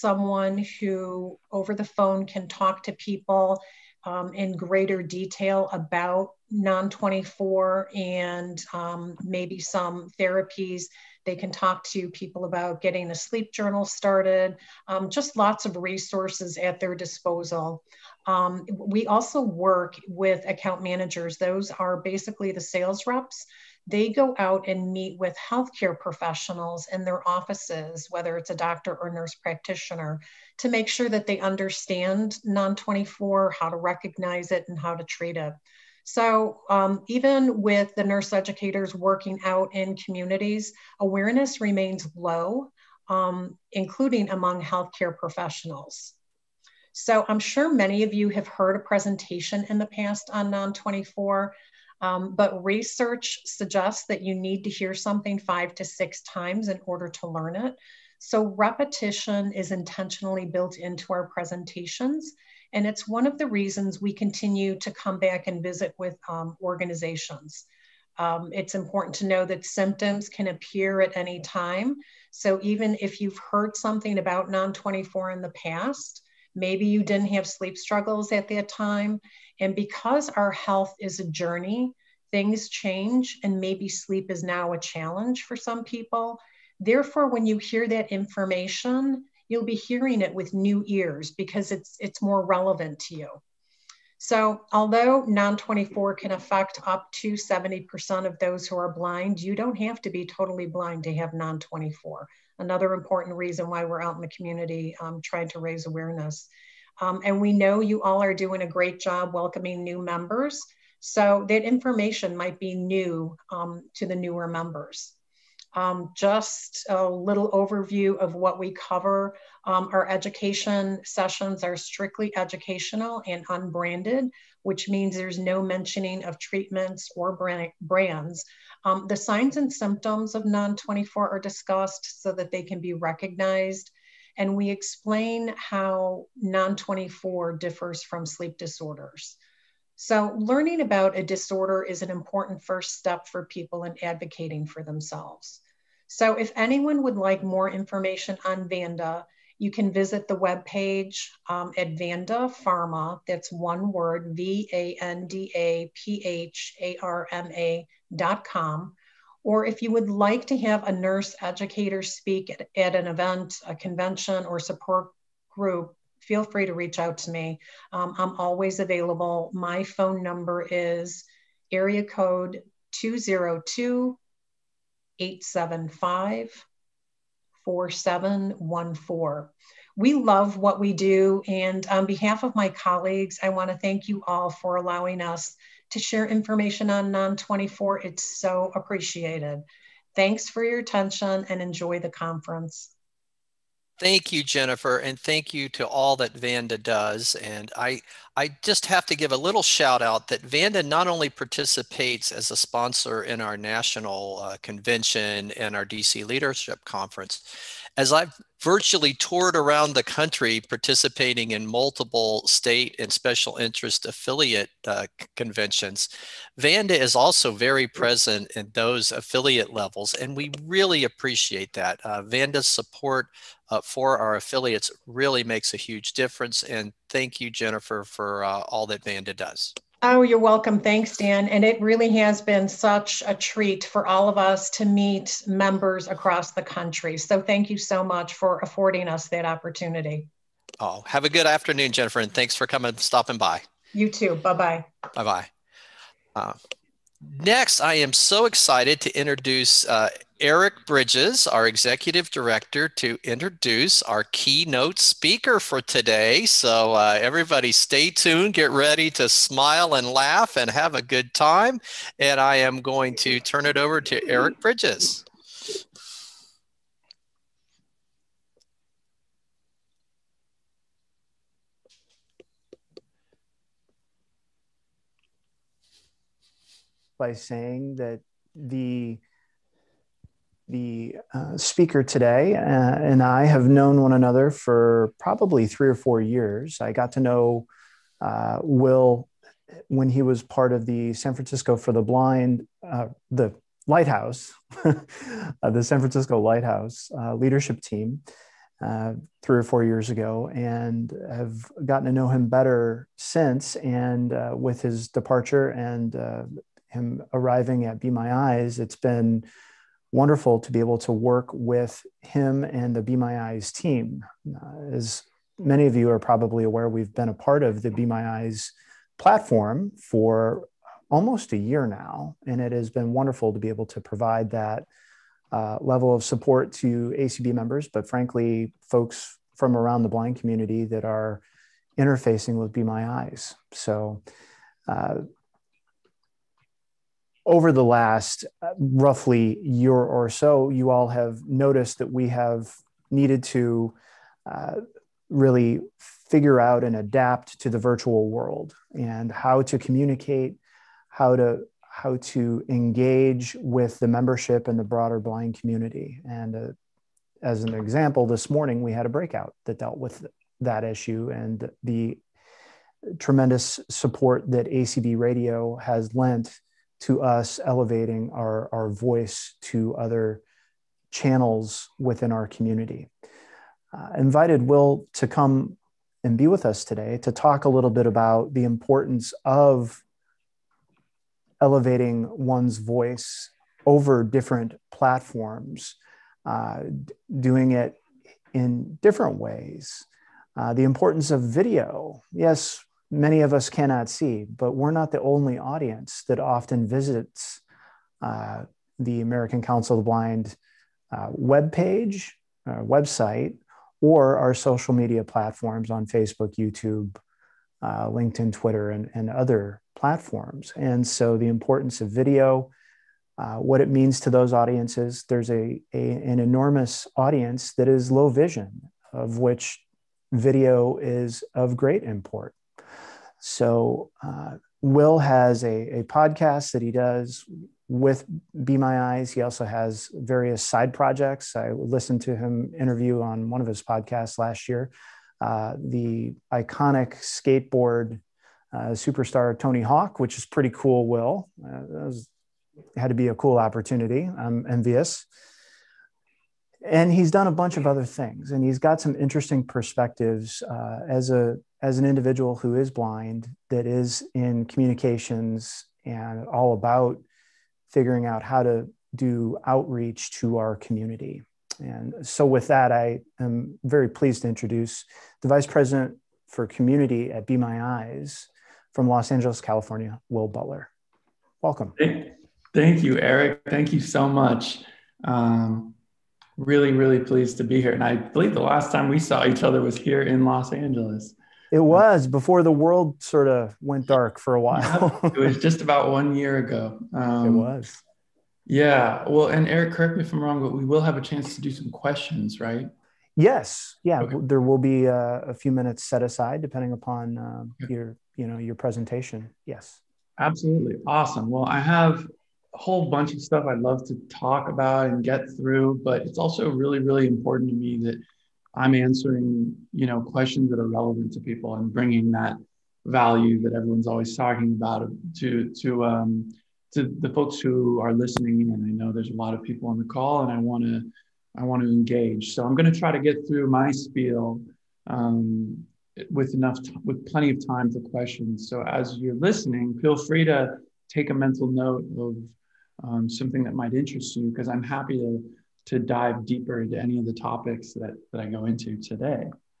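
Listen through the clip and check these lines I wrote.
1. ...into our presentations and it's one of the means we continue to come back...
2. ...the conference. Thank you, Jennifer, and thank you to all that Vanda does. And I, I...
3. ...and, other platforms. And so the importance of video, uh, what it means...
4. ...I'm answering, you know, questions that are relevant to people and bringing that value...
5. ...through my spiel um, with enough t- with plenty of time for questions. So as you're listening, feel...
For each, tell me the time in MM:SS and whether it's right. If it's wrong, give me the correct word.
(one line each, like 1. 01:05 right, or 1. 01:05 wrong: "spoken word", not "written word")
1. 01:00 wrong: "reasons", not "means"
2. 03:11 right
3. 06:49 right
4. 08:28 right
5. 08:43 right.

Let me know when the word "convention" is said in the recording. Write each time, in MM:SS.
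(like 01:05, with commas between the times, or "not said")
02:43, 03:24, 03:35.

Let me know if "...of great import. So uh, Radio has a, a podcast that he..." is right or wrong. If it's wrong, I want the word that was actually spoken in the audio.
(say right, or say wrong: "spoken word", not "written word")
wrong: "Will", not "Radio".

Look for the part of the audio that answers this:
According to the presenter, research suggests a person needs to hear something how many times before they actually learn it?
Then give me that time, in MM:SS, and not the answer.
00:55.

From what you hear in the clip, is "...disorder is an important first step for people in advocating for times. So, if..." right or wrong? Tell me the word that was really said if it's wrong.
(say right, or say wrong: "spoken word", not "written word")
wrong: "themselves", not "times".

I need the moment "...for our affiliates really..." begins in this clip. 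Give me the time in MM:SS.
03:43.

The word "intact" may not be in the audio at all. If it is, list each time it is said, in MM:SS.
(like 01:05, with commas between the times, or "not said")
not said.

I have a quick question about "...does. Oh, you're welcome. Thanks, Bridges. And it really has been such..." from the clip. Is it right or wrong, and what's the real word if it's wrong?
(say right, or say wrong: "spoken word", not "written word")
wrong: "Dan", not "Bridges".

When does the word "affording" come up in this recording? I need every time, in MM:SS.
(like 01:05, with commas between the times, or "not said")
03:58.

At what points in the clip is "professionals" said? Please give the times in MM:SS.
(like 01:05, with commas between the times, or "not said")
00:25, 00:45.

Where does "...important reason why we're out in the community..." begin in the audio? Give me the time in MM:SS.
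01:42.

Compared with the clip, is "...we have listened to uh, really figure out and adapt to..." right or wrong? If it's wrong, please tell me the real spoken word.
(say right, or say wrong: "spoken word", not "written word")
wrong: "needed", not "listened".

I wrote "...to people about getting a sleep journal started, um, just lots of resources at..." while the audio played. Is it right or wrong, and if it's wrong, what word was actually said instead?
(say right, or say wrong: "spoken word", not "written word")
right.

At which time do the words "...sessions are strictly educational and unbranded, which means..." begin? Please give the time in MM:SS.
02:01.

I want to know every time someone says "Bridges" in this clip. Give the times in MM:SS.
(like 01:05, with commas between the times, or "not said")
04:10, 04:24.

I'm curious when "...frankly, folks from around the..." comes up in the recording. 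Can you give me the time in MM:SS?
05:28.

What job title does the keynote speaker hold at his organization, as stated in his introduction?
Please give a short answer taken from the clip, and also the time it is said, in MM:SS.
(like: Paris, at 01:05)
Vice President for Community, at 07:45.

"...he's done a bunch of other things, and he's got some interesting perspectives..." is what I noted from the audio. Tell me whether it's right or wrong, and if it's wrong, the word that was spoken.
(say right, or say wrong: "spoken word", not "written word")
right.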